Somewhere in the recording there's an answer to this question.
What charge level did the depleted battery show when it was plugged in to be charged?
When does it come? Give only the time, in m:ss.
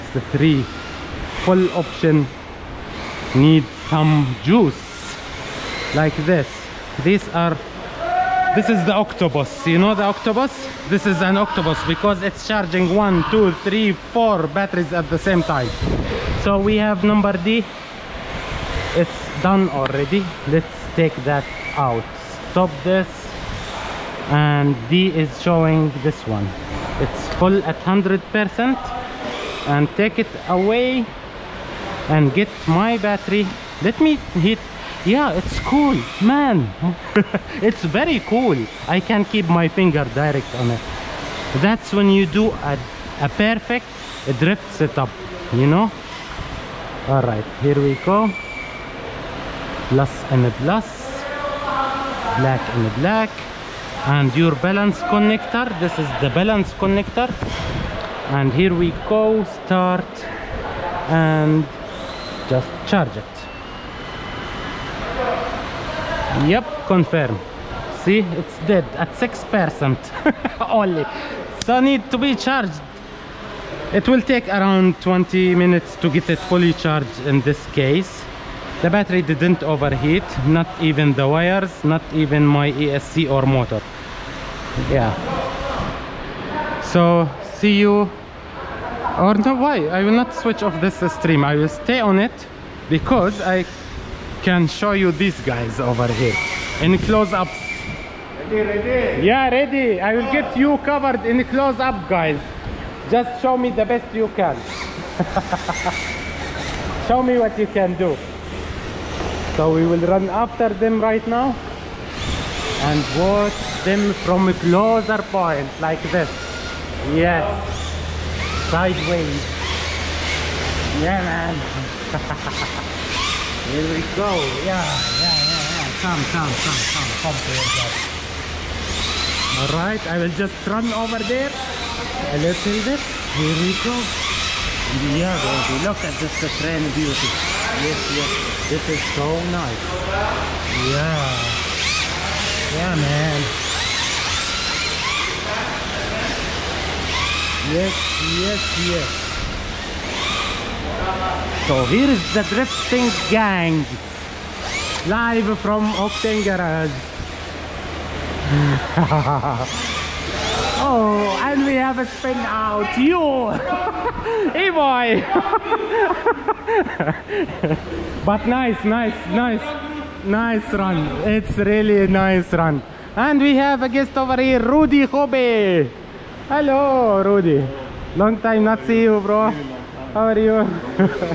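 1:09.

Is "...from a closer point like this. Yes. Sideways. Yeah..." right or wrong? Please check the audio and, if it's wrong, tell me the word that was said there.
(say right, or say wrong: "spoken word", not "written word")
right.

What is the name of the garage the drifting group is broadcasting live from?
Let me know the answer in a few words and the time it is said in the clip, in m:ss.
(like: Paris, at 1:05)
Octane Garage, at 2:35.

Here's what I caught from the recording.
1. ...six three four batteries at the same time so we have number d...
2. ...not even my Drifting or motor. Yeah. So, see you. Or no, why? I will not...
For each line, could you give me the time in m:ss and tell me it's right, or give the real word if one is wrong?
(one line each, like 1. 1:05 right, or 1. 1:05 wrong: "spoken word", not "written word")
1. 0:13 wrong: "two", not "six"
2. 1:21 wrong: "ESC", not "Drifting".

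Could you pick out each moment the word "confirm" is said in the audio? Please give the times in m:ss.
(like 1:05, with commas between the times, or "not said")
1:06.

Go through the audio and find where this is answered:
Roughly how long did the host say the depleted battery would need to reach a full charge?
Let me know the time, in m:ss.
1:15.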